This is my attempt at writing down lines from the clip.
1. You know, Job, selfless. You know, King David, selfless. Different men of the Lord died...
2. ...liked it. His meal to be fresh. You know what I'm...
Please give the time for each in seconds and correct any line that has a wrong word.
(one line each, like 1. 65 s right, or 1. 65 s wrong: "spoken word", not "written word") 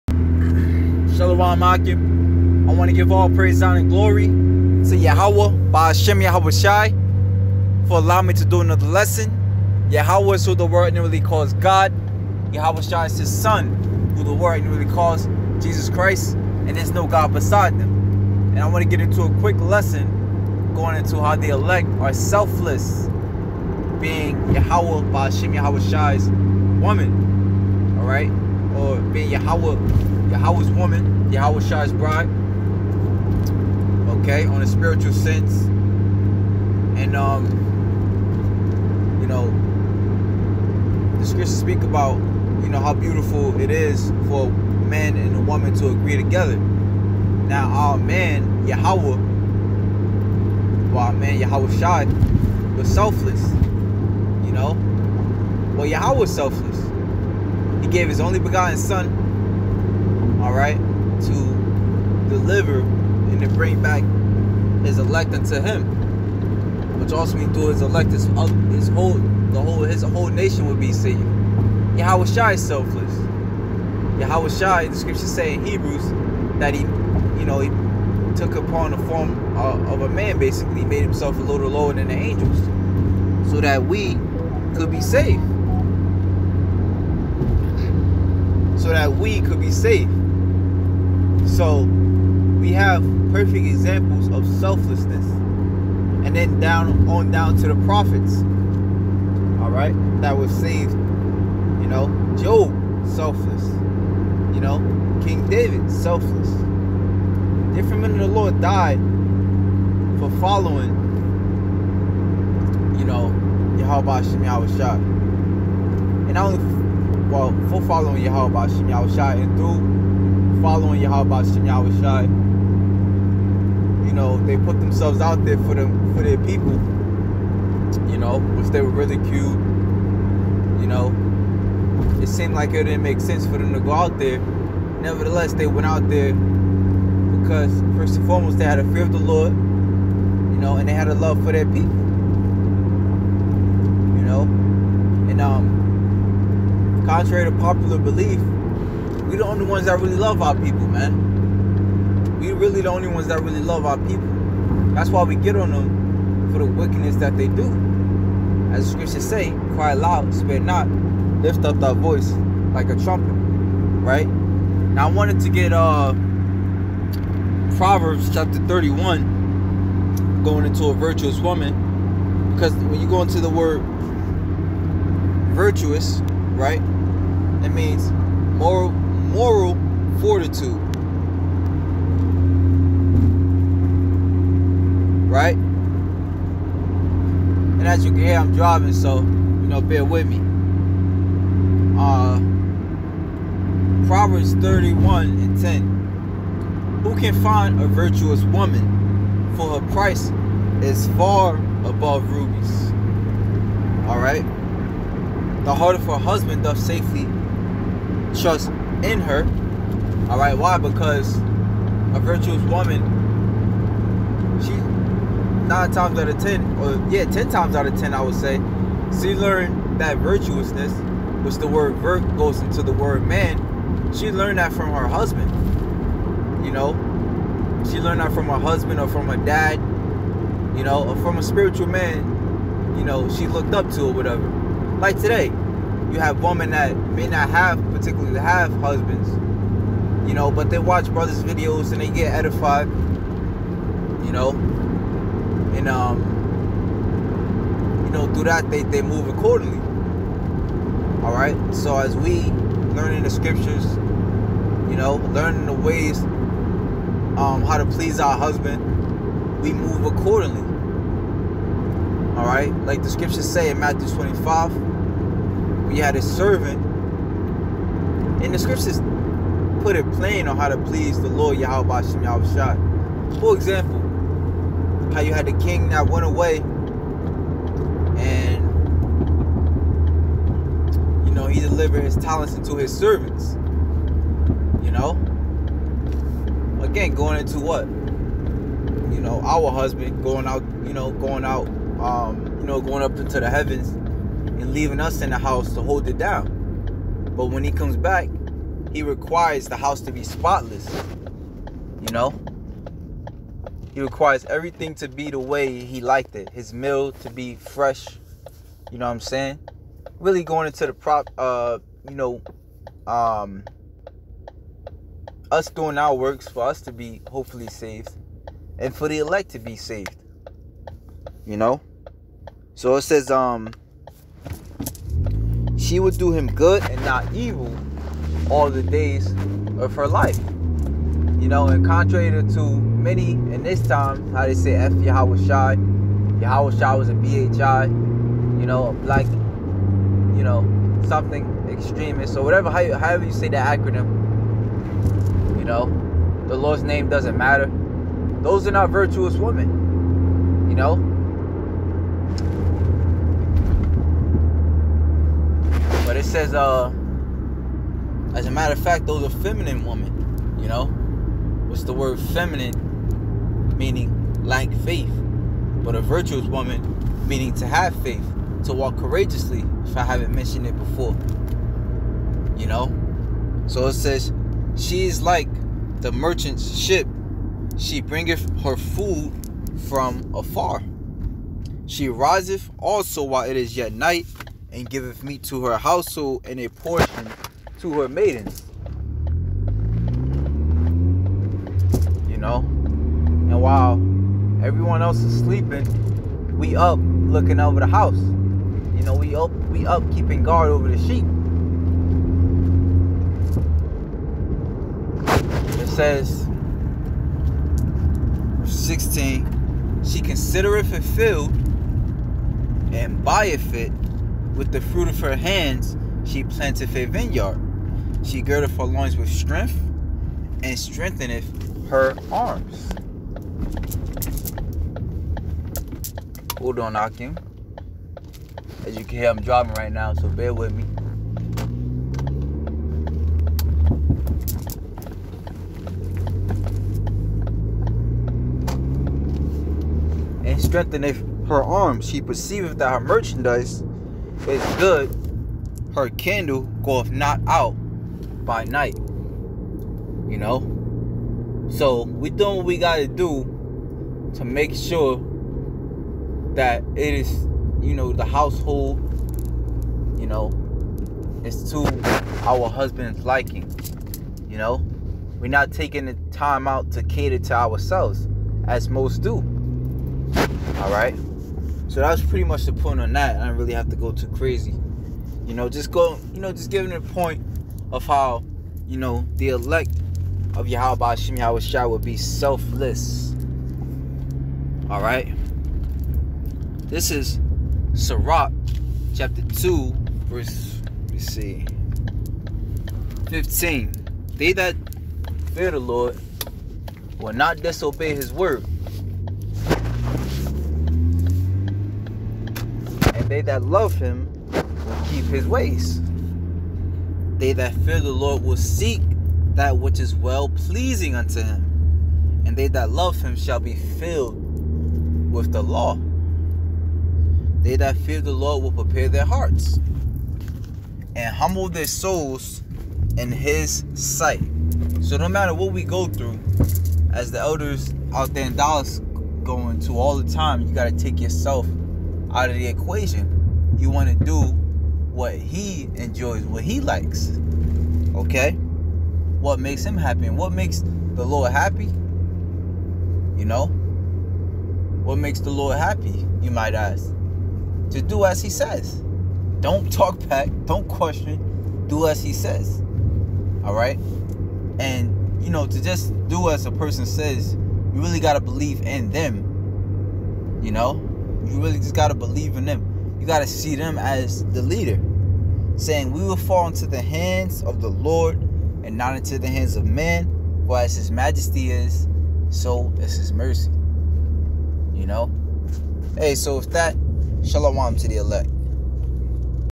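1. 100 s right
2. 306 s right.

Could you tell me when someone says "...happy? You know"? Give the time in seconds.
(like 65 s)
541 s.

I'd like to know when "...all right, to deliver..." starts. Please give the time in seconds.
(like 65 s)
60 s.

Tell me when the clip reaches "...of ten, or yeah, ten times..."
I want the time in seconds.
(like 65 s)
216 s.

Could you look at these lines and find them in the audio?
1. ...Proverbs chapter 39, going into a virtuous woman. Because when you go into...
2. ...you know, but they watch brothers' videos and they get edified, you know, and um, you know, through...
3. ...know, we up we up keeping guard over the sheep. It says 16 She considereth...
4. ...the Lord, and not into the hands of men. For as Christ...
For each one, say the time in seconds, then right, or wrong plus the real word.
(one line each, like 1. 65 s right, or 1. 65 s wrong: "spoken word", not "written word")
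1. 167 s wrong: "31", not "39"
2. 240 s right
3. 399 s right
4. 567 s wrong: "His", not "Christ".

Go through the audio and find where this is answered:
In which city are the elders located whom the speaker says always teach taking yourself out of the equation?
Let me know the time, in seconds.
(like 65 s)
528 s.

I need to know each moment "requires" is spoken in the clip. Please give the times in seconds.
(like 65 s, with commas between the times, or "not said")
299 s, 304 s.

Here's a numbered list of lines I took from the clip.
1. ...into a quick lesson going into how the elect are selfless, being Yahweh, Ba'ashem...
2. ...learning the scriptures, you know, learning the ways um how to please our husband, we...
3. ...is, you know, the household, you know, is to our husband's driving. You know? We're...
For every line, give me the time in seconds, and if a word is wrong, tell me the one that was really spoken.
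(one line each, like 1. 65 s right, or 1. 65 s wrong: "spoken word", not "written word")
1. 18 s right
2. 252 s right
3. 457 s wrong: "liking", not "driving".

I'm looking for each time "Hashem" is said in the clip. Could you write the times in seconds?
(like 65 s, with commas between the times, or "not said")
481 s.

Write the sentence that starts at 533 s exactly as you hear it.
You want to do what he enjoys, what he likes.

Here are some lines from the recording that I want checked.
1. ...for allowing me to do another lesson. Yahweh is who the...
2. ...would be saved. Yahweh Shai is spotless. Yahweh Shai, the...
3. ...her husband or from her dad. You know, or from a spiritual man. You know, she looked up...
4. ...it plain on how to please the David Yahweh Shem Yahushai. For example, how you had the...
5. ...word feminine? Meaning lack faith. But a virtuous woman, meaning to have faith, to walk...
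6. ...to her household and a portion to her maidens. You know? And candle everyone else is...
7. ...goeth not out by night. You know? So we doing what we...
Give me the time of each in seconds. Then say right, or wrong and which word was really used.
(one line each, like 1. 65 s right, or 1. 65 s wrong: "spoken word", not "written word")
1. 7 s right
2. 70 s wrong: "selfless", not "spotless"
3. 228 s right
4. 269 s wrong: "Lord", not "David"
5. 361 s right
6. 385 s wrong: "while", not "candle"
7. 446 s right.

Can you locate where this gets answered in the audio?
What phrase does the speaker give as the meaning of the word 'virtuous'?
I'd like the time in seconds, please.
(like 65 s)
179 s.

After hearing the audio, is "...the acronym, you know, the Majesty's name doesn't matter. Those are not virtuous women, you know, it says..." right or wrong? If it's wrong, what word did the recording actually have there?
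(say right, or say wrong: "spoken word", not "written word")
wrong: "Lord", not "Majesty".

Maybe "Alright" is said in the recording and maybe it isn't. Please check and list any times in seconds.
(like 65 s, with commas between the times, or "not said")
99 s, 204 s, 470 s, 484 s.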